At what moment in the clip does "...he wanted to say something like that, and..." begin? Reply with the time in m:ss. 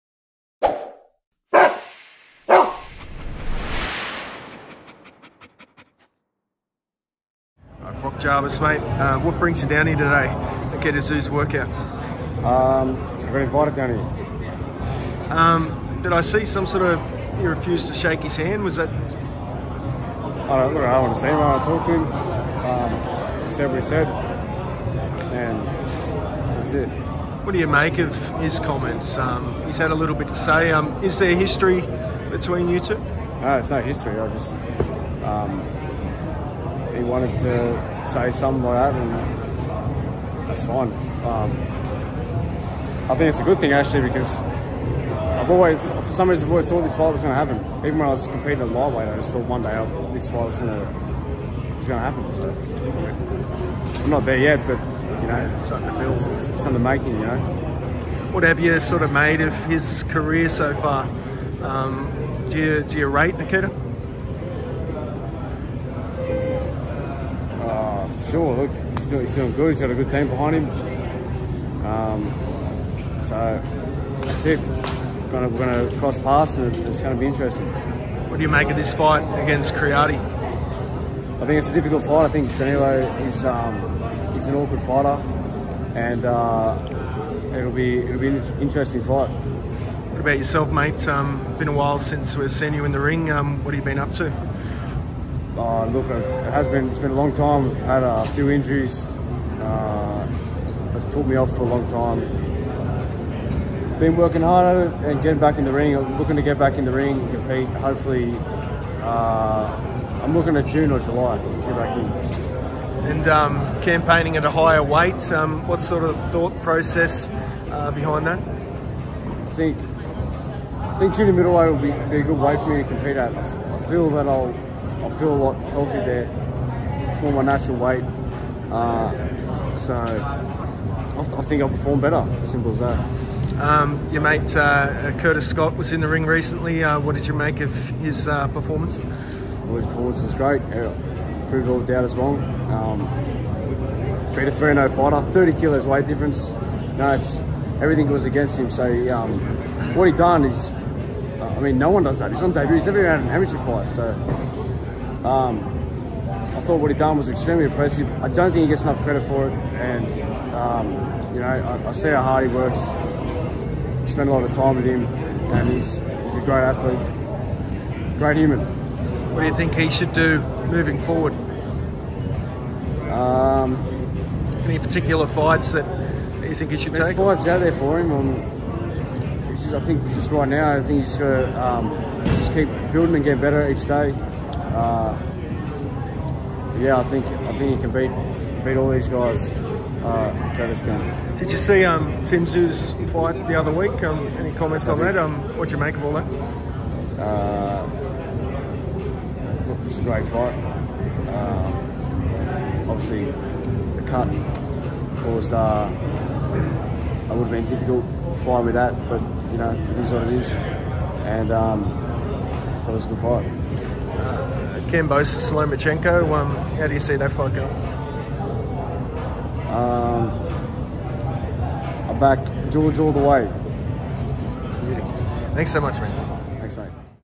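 0:37.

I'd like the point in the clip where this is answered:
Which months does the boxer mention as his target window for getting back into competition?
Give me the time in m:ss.
1:50.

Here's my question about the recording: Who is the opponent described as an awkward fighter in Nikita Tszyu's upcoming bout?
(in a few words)
Danilo.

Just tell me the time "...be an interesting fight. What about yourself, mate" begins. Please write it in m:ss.
1:28.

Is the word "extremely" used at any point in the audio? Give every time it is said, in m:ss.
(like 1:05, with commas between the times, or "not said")
2:37.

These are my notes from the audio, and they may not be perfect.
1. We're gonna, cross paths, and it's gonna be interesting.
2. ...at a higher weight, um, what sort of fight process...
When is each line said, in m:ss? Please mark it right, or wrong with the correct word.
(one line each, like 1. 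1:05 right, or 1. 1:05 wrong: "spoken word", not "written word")
1. 1:15 right
2. 1:54 wrong: "thought", not "fight".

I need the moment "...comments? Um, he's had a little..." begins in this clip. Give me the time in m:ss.
0:28.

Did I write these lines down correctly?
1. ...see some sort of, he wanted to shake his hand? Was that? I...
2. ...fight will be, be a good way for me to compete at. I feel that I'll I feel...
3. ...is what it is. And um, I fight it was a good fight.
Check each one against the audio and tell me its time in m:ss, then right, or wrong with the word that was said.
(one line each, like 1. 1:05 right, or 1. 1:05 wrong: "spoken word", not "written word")
1. 0:16 wrong: "refused", not "wanted"
2. 2:01 wrong: "middleweight", not "fight"
3. 3:29 wrong: "thought", not "fight".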